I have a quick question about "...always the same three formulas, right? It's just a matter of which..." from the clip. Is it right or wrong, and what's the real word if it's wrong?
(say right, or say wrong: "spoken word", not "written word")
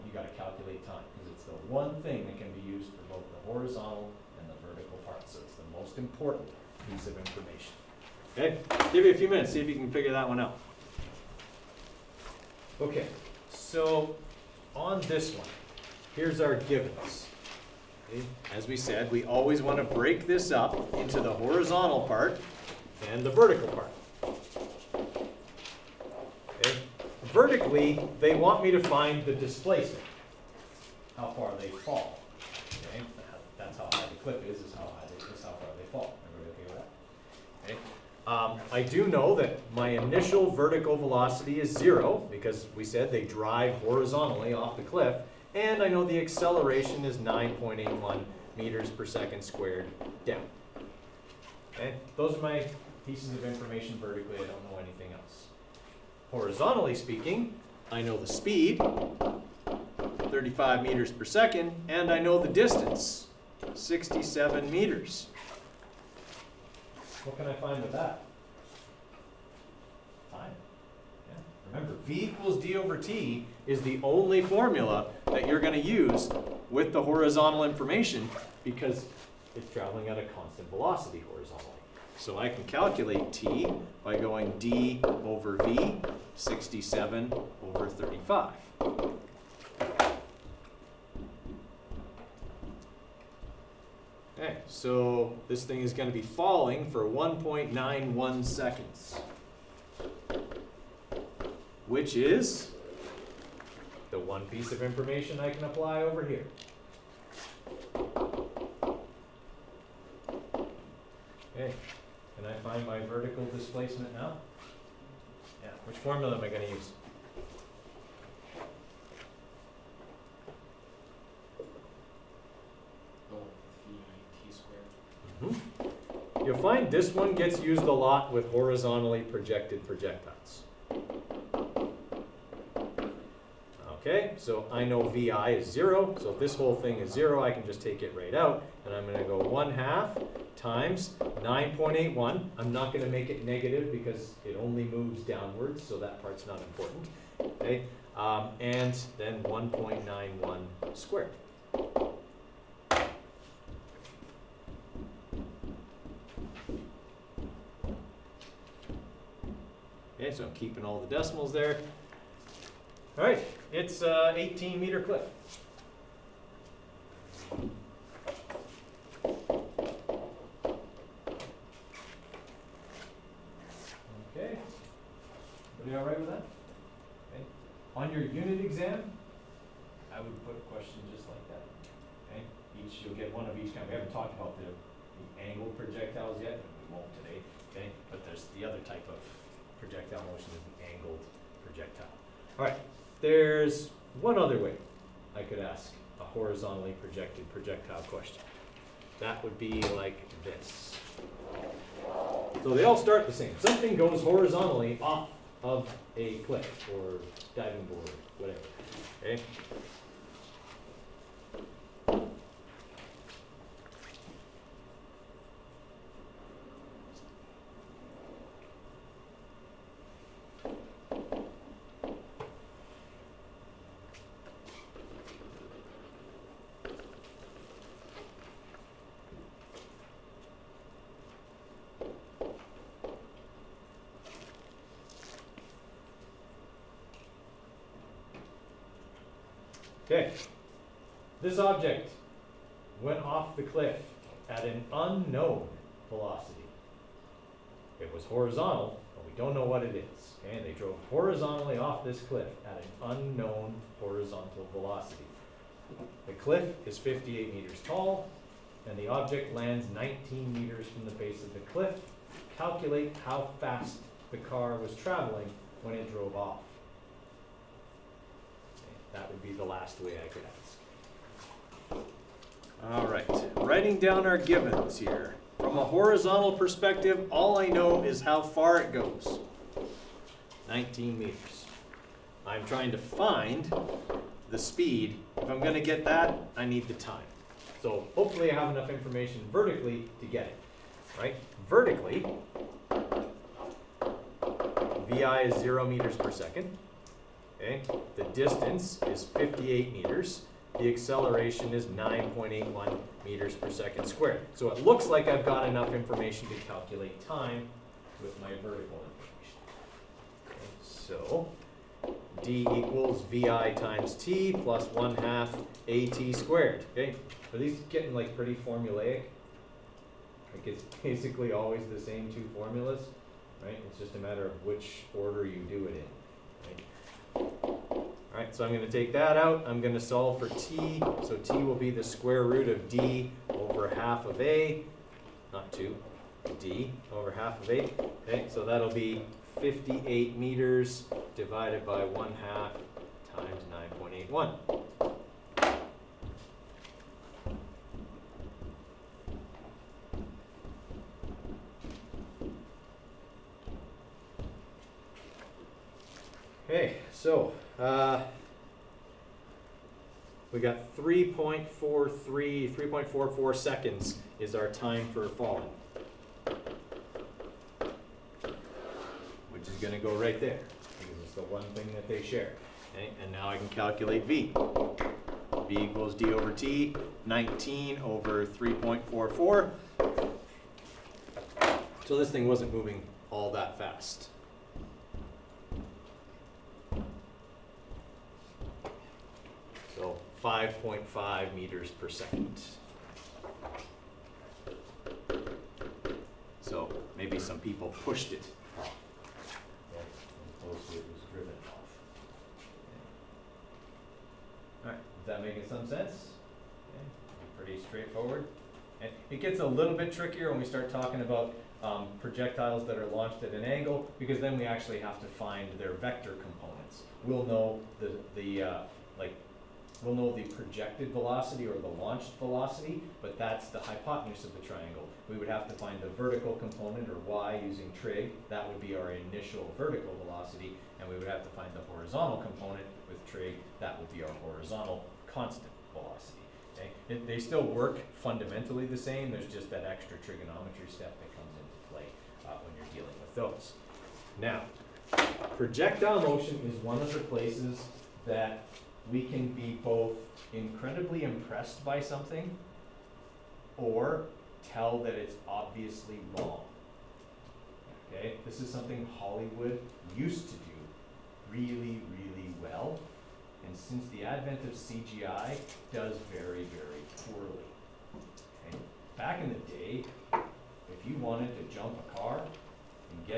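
wrong: "two", not "three".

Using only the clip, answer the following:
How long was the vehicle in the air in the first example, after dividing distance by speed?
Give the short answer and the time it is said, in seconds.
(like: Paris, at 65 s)
1.91 seconds, at 97 s.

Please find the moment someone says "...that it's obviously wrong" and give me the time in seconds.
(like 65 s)
454 s.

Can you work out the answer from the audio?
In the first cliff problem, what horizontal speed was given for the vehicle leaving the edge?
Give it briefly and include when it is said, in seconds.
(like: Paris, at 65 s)
35 meters per second, at 60 s.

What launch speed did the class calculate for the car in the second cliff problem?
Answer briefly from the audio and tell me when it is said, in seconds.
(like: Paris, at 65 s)
5.5 meters per second, at 390 s.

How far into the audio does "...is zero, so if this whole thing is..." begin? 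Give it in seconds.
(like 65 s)
135 s.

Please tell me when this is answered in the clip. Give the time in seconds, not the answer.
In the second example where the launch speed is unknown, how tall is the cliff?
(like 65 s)
256 s.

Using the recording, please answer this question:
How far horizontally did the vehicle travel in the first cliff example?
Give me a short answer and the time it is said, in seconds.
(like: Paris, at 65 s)
67 meters, at 63 s.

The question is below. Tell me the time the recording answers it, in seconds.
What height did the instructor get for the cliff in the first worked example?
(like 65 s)
164 s.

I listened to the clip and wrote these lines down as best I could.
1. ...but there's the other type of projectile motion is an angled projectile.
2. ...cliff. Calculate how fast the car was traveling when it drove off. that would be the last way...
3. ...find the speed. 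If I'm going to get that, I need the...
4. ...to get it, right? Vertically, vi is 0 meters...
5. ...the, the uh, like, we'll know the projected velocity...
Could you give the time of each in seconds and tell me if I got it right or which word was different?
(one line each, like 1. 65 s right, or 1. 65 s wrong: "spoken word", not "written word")
1. 188 s right
2. 261 s right
3. 282 s right
4. 290 s right
5. 417 s right.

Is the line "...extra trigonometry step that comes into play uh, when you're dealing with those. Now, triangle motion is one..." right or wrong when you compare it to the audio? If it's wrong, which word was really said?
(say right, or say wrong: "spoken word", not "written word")
wrong: "projectile", not "triangle".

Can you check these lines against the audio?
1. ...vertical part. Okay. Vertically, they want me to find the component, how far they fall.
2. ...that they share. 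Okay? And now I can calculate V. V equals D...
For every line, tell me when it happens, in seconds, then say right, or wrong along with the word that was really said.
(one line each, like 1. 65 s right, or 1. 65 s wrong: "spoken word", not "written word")
1. 23 s wrong: "displacement", not "component"
2. 371 s right.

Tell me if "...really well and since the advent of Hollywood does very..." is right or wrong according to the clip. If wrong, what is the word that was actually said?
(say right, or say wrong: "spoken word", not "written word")
wrong: "CGI", not "Hollywood".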